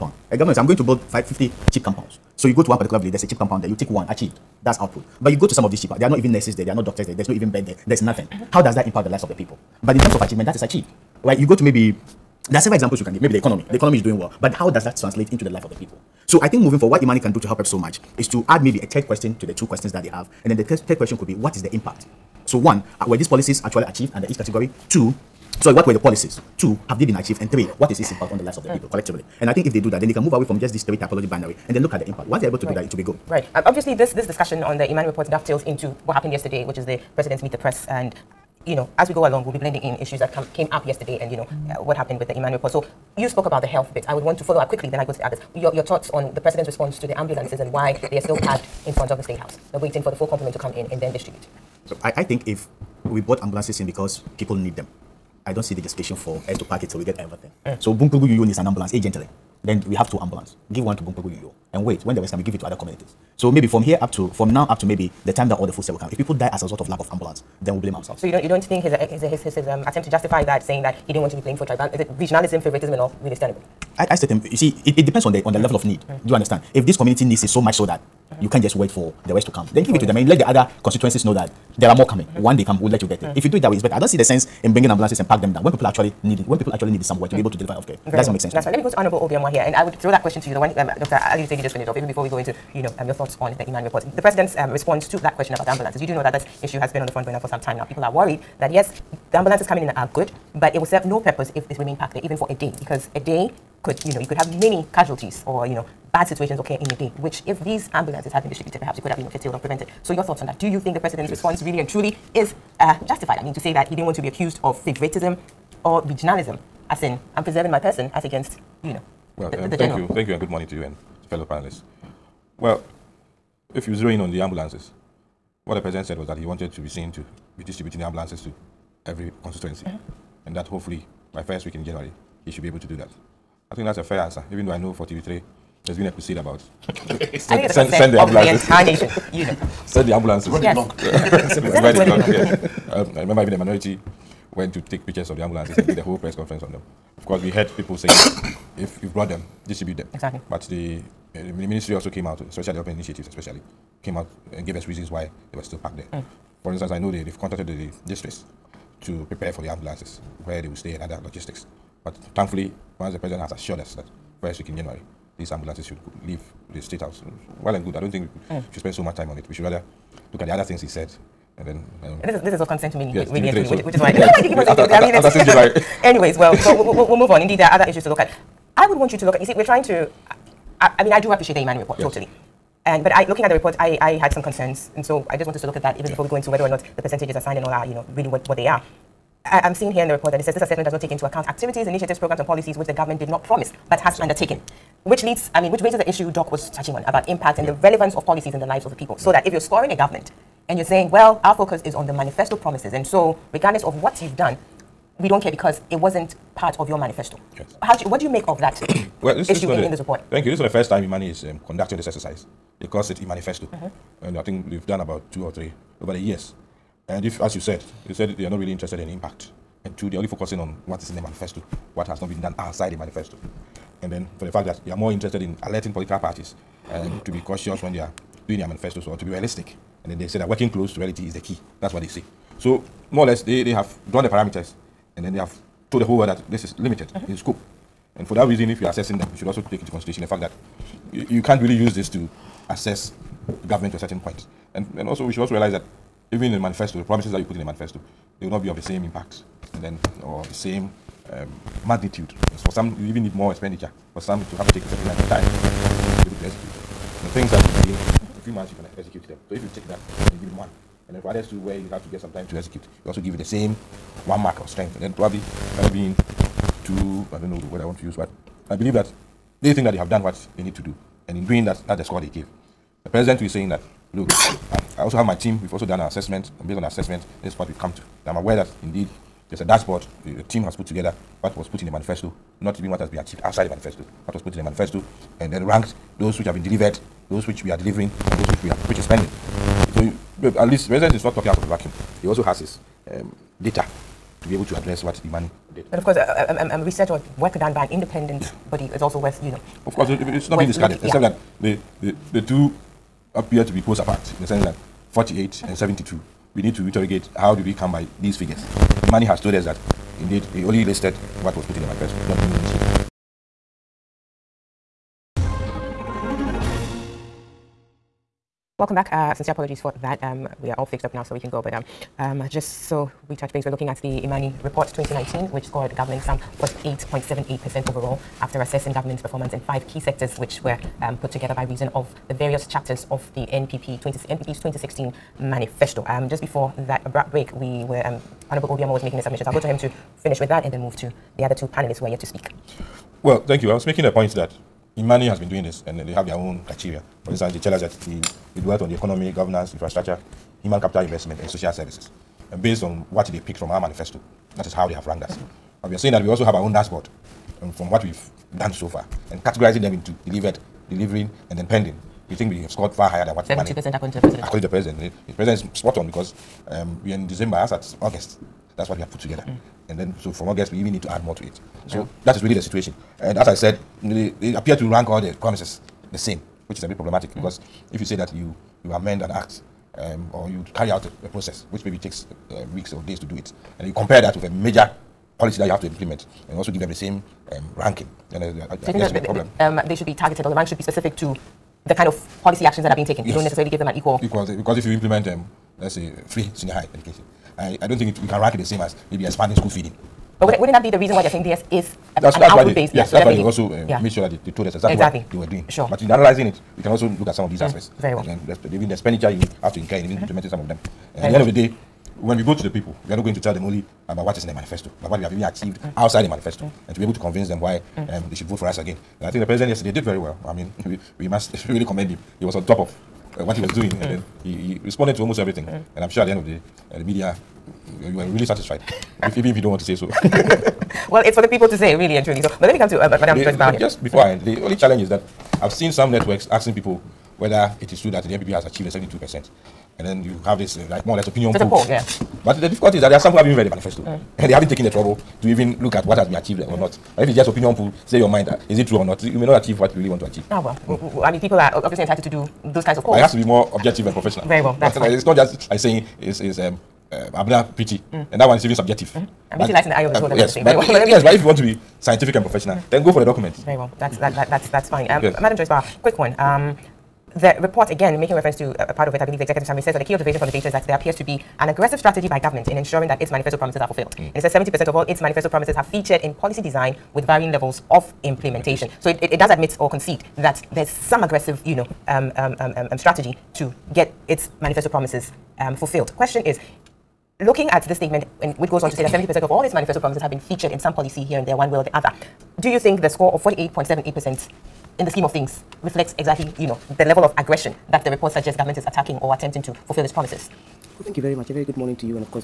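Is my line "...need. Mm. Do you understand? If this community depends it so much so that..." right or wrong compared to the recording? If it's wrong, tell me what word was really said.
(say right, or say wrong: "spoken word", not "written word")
wrong: "needs", not "depends".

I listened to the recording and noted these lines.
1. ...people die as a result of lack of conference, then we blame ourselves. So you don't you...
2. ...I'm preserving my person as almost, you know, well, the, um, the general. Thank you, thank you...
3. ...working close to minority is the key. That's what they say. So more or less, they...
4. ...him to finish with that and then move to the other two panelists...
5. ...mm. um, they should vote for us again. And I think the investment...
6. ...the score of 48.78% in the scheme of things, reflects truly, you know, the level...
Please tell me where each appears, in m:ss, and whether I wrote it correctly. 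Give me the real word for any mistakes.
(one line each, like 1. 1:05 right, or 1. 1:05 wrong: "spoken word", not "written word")
1. 1:06 wrong: "ambulance", not "conference"
2. 1:57 wrong: "against", not "almost"
3. 3:50 wrong: "reality", not "minority"
4. 5:39 right
5. 6:57 wrong: "president", not "investment"
6. 8:13 wrong: "exactly", not "truly".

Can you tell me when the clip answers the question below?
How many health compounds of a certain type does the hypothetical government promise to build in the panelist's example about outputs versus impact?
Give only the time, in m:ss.
0:01.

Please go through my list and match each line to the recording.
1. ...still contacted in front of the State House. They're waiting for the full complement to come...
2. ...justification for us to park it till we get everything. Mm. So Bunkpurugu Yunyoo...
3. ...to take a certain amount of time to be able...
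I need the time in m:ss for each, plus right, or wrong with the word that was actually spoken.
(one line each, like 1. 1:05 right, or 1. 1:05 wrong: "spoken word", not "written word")
1. 0:48 wrong: "parked", not "contacted"
2. 0:55 right
3. 4:14 right.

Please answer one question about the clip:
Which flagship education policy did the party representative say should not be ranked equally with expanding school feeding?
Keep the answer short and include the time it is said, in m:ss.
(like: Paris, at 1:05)
Free senior high education, at 6:36.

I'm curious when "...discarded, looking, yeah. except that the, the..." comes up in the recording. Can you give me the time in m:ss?
5:00.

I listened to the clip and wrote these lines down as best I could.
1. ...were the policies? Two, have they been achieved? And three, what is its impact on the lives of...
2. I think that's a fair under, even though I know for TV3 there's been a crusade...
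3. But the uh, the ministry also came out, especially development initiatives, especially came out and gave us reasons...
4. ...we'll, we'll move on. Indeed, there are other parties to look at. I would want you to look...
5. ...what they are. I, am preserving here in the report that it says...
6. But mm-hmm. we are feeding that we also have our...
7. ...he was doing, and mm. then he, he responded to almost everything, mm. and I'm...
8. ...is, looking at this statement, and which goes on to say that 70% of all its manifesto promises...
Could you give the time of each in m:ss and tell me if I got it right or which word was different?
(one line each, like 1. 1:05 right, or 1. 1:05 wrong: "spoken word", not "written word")
1. 0:25 right
2. 2:13 wrong: "answer", not "under"
3. 2:30 right
4. 2:56 wrong: "issues", not "parties"
5. 3:08 wrong: "seeing", not "preserving"
6. 5:55 wrong: "saying", not "feeding"
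7. 7:03 right
8. 8:06 right.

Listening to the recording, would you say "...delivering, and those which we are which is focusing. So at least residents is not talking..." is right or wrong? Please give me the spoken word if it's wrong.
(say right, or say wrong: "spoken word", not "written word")
wrong: "pending", not "focusing".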